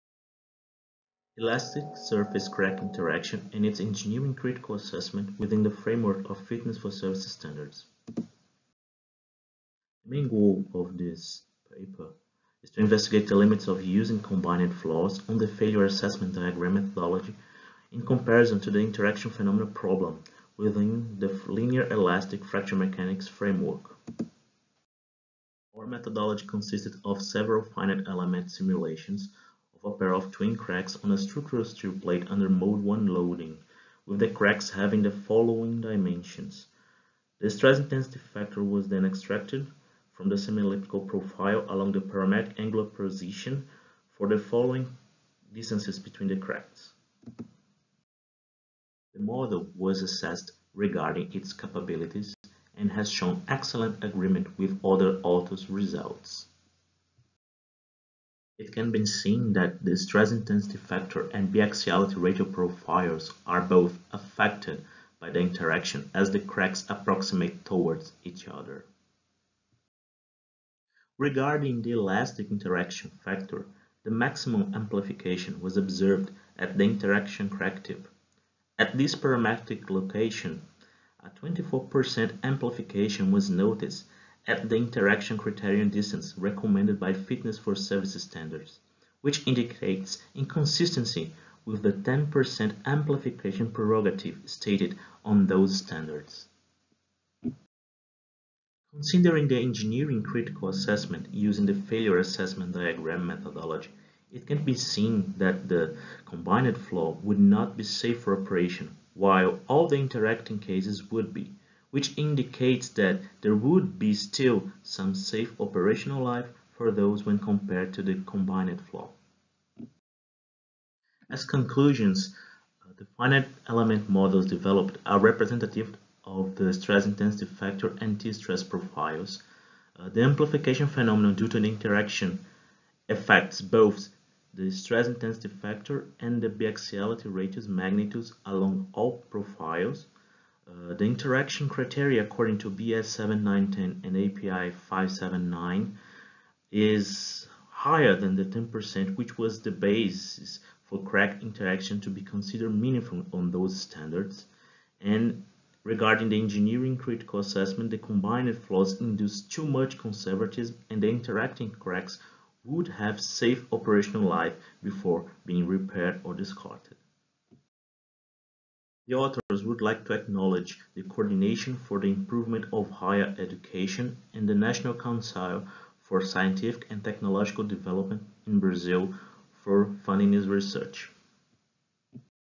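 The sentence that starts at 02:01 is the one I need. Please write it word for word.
As conclusions, uh, the finite element models developed are representative of the stress intensity factor and T-stress profiles.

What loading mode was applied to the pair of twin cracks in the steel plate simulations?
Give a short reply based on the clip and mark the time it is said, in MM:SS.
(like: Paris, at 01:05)
Mode 1, at 00:32.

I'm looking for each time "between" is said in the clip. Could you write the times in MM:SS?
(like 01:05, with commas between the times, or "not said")
00:45.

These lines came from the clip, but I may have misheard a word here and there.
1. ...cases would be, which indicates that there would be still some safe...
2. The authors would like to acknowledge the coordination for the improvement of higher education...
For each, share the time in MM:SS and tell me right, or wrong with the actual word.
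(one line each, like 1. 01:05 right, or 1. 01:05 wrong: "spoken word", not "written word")
1. 01:50 right
2. 02:49 right.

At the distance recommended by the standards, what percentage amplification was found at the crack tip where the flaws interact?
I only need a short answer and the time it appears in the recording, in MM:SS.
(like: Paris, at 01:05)
24%, at 01:21.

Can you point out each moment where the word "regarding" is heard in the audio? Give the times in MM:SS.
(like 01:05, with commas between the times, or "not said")
00:50, 01:11, 02:35.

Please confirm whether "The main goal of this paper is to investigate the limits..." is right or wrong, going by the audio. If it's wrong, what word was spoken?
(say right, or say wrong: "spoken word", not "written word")
right.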